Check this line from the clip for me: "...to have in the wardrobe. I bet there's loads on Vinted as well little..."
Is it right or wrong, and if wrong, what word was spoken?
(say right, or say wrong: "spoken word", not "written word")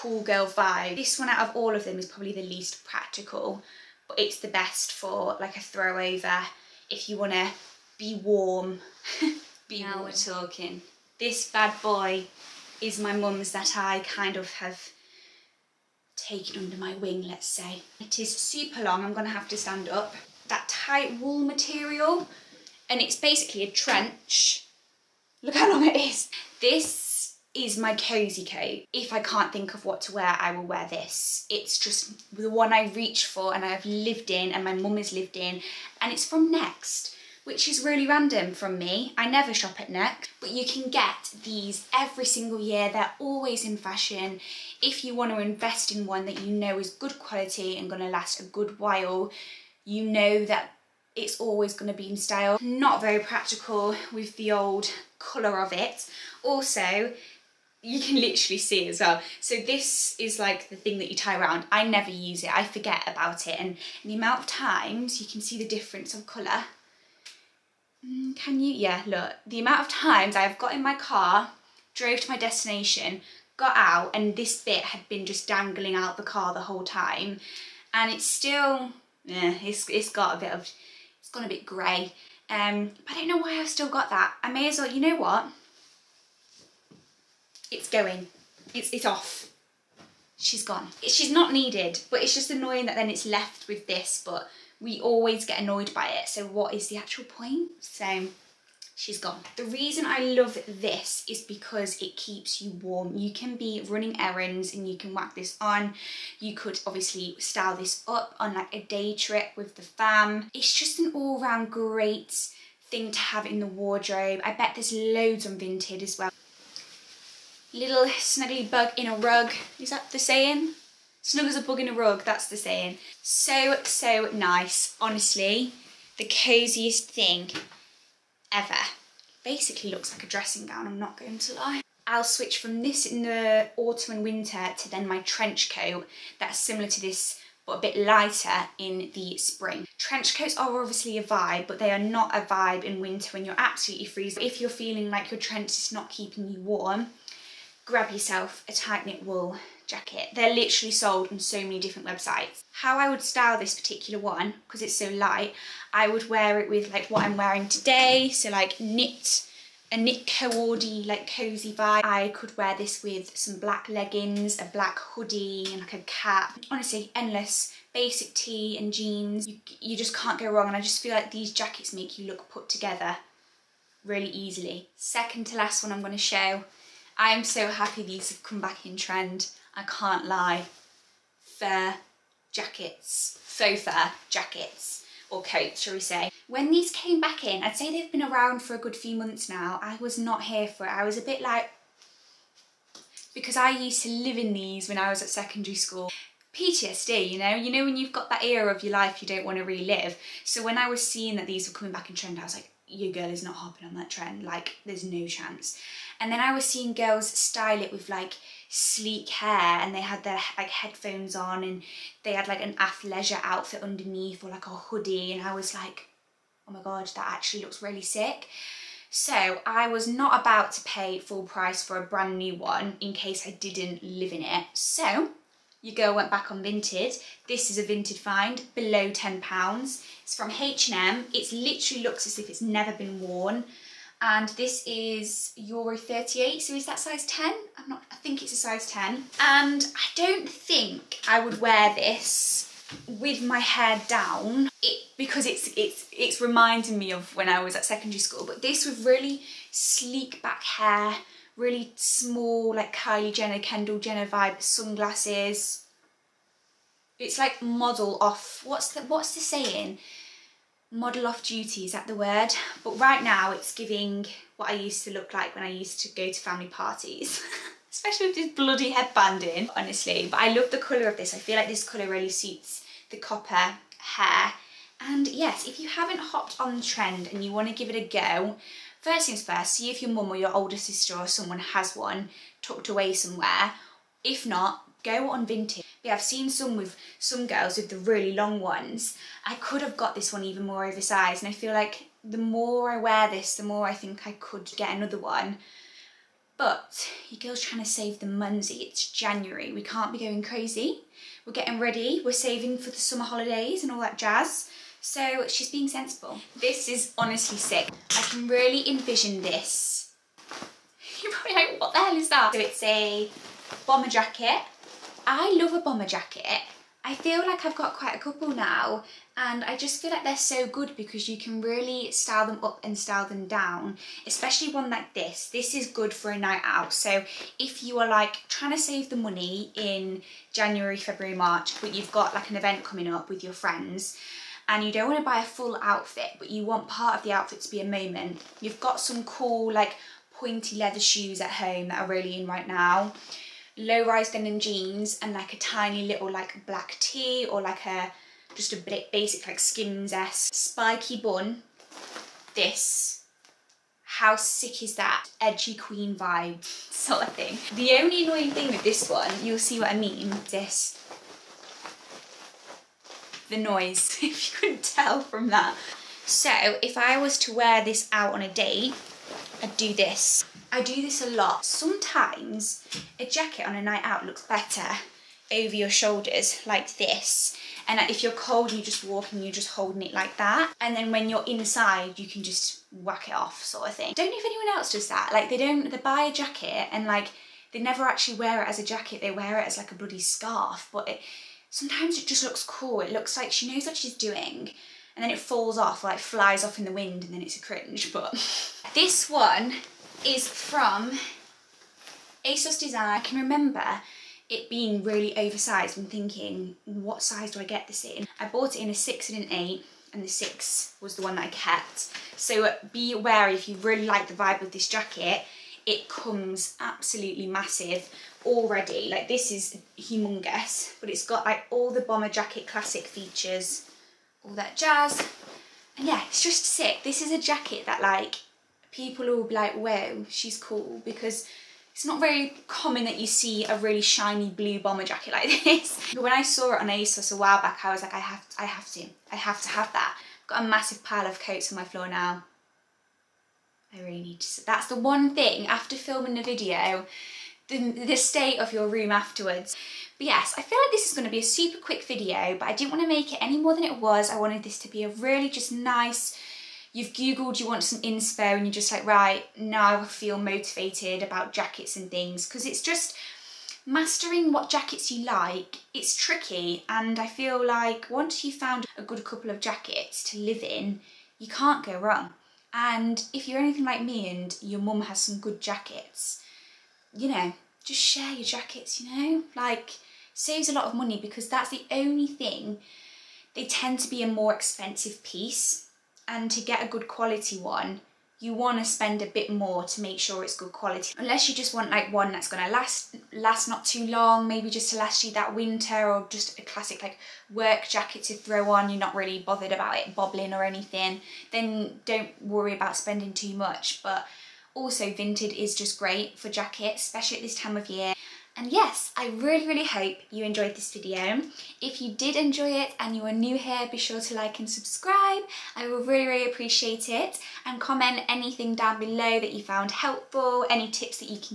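right.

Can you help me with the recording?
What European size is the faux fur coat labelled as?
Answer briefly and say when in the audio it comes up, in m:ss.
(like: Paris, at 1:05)
Euro 38, at 3:55.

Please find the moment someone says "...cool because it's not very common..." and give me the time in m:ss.
7:10.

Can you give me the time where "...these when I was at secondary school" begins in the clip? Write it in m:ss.
3:14.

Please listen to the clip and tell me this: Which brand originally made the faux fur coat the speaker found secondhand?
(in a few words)
H&M.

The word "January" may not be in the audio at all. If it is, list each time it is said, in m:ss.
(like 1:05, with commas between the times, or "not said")
4:59, 5:30.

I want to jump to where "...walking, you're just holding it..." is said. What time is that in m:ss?
6:19.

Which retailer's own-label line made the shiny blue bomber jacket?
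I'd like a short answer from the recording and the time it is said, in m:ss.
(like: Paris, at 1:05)
ASOS Design, at 6:42.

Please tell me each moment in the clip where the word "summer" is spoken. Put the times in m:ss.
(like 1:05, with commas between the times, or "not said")
5:02.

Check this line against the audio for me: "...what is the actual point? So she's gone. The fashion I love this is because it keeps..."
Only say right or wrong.
wrong.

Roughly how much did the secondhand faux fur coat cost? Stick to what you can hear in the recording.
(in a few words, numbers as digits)
below £10.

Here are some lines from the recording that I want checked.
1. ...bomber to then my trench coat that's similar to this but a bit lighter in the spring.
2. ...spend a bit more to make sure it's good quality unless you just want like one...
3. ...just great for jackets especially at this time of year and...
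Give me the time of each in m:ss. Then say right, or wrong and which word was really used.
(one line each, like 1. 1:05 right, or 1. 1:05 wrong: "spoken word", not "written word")
1. 2:14 wrong: "winter", not "bomber"
2. 8:08 right
3. 8:25 right.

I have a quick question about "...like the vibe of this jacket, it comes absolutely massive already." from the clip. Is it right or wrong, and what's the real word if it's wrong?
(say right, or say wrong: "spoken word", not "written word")
right.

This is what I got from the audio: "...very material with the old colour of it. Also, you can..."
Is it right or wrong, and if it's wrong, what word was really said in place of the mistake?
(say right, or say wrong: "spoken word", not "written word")
wrong: "practical", not "material".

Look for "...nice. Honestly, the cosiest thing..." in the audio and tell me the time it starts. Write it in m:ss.
2:04.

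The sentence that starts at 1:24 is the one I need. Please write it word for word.
I may as well, you know what?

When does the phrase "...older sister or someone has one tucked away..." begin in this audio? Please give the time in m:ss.
4:40.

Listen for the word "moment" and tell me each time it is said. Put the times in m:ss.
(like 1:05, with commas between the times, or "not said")
5:37.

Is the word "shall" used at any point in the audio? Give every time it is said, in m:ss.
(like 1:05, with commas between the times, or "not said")
3:05.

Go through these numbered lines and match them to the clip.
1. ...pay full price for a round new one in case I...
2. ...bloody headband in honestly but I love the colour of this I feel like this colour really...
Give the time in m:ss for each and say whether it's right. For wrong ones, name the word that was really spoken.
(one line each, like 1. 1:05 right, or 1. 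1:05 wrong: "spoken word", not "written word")
1. 3:40 wrong: "brand", not "round"
2. 4:28 right.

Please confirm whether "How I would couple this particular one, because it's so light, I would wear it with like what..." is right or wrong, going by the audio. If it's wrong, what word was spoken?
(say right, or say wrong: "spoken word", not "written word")
wrong: "style", not "couple".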